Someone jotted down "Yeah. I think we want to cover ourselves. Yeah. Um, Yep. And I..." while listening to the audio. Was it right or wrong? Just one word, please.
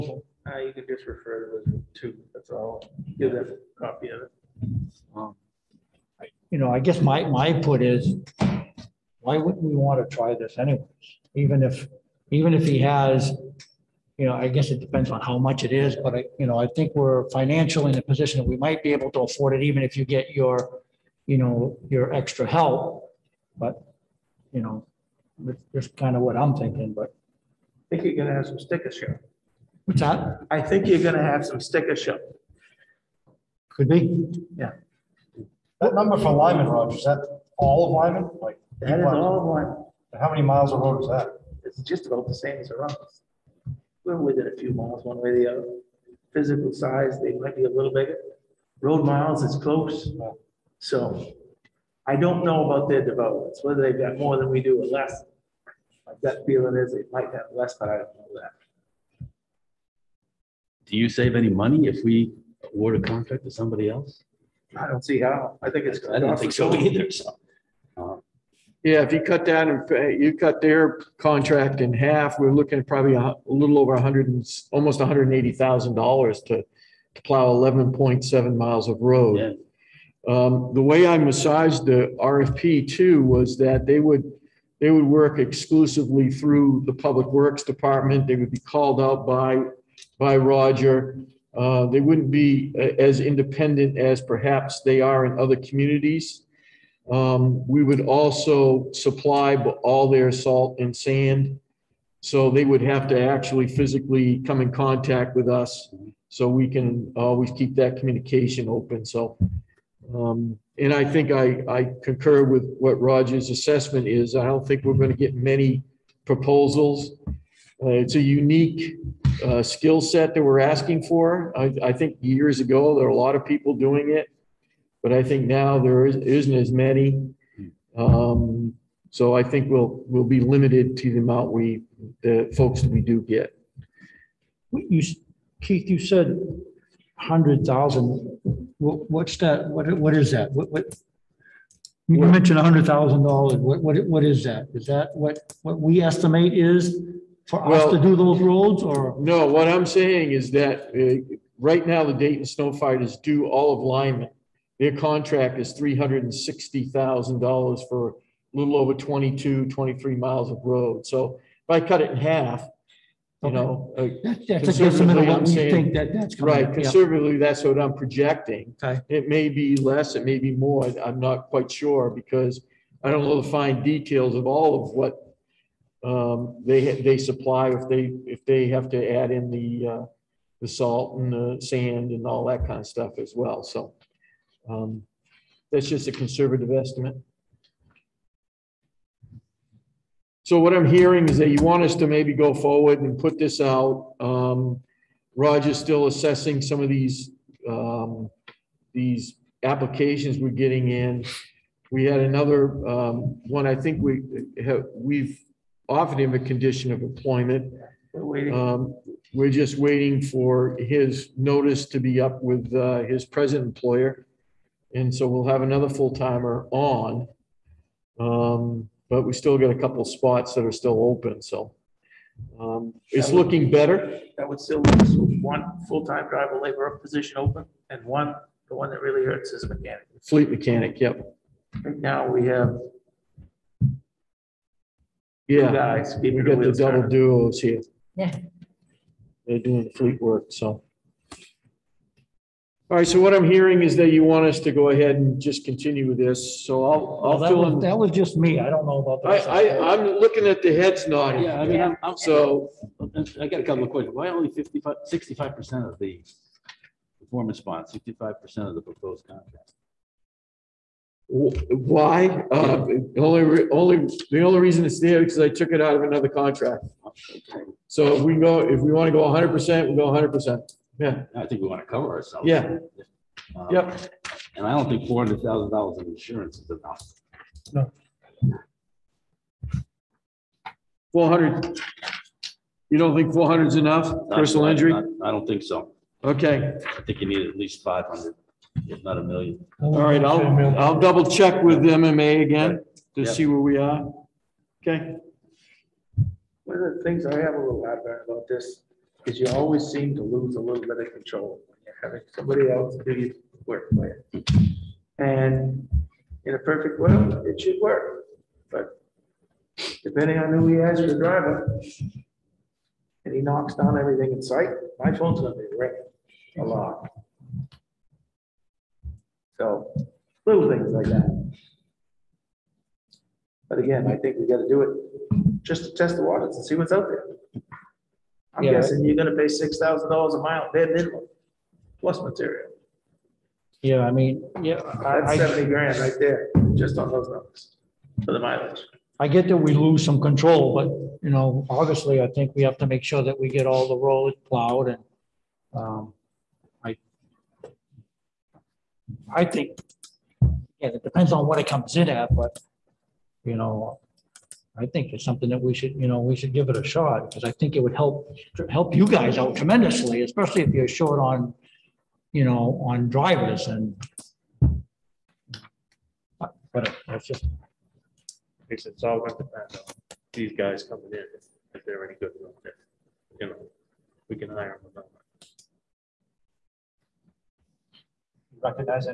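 right.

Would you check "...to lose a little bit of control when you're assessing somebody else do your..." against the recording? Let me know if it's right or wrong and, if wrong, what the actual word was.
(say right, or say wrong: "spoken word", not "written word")
wrong: "having", not "assessing".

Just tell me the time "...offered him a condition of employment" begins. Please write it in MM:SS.
03:25.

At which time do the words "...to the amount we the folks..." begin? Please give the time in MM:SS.
02:10.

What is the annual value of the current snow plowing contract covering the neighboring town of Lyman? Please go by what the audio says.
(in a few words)
$360,000.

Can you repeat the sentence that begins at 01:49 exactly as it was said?
So, um, and I think I, I concur with what Roger's assessment is.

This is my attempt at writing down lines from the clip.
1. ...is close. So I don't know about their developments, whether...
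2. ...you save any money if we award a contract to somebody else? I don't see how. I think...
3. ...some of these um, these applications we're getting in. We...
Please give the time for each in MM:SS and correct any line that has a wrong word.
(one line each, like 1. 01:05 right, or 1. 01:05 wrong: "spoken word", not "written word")
1. 00:49 right
2. 01:00 right
3. 03:16 right.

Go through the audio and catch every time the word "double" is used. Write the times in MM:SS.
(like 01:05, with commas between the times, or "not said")
03:56, 04:50.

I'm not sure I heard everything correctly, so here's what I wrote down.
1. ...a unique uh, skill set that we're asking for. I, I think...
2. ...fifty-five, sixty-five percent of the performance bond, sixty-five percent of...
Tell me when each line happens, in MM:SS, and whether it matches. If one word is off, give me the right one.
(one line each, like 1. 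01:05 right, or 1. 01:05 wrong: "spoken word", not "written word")
1. 01:58 right
2. 04:14 right.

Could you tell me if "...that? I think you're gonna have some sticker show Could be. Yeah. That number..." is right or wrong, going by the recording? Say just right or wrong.
right.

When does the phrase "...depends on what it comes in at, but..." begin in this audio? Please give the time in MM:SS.
05:51.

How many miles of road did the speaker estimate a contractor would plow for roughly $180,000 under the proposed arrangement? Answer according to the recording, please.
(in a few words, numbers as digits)
11.7.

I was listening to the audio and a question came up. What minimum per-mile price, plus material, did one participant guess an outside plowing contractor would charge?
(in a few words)
$6,000.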